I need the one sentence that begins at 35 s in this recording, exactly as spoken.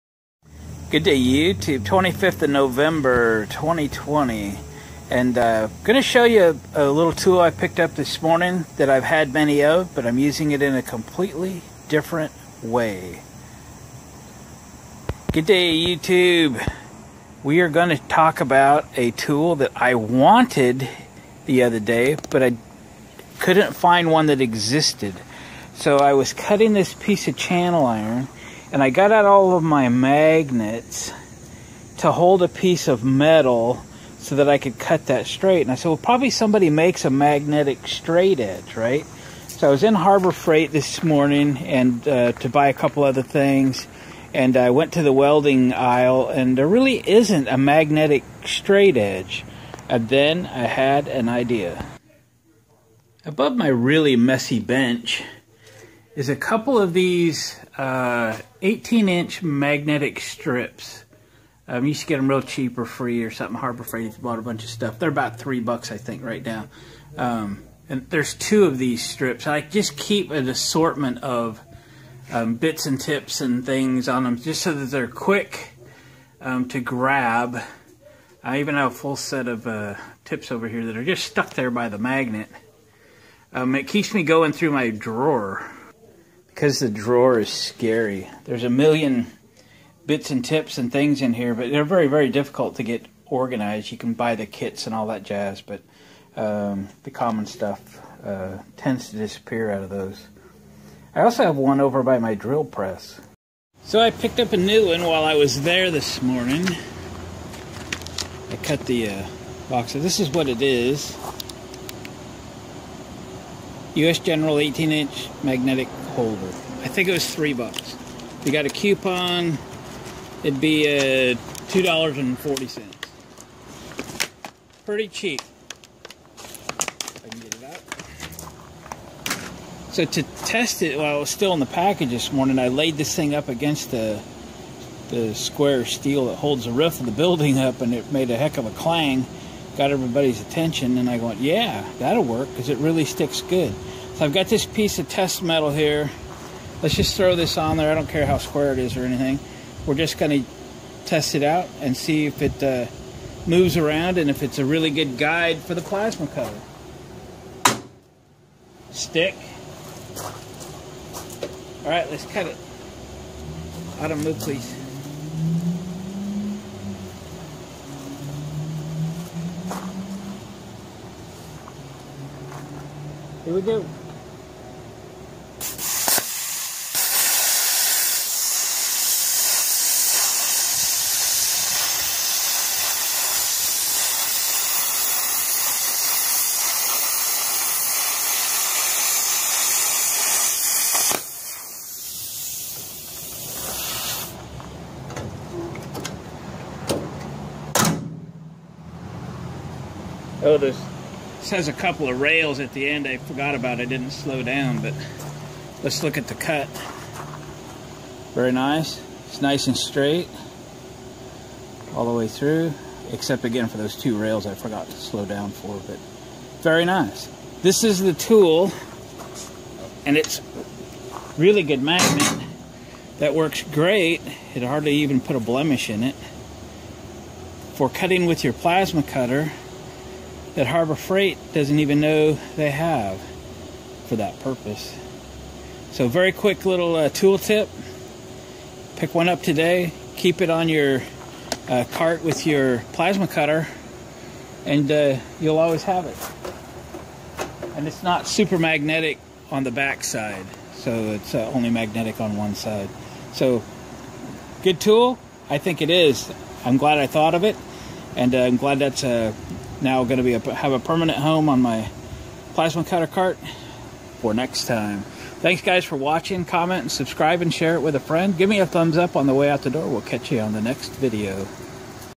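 And I said, well, probably somebody makes a magnetic straight edge, right?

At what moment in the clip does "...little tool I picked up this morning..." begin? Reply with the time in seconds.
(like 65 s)
6 s.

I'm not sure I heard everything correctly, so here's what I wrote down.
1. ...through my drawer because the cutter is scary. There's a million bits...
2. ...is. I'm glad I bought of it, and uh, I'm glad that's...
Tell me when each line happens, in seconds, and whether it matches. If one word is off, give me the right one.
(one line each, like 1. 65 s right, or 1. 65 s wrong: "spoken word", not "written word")
1. 84 s wrong: "drawer", not "cutter"
2. 255 s wrong: "thought", not "bought".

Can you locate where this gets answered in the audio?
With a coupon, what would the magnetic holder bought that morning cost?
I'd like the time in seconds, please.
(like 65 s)
121 s.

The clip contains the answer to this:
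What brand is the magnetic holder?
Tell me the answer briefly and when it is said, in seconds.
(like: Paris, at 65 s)
US General, at 113 s.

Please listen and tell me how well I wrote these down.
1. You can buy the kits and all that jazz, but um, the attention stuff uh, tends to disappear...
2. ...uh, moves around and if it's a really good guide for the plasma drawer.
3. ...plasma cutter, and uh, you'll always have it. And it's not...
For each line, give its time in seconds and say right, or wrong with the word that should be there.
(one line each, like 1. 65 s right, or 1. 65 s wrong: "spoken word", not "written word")
1. 93 s wrong: "common", not "attention"
2. 152 s wrong: "cutter", not "drawer"
3. 242 s right.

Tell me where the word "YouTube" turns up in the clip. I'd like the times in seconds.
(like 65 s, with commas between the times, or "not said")
1 s, 15 s.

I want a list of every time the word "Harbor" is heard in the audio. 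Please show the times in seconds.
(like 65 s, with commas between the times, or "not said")
39 s, 63 s, 230 s.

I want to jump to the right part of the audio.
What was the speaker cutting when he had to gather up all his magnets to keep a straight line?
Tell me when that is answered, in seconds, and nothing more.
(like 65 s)
27 s.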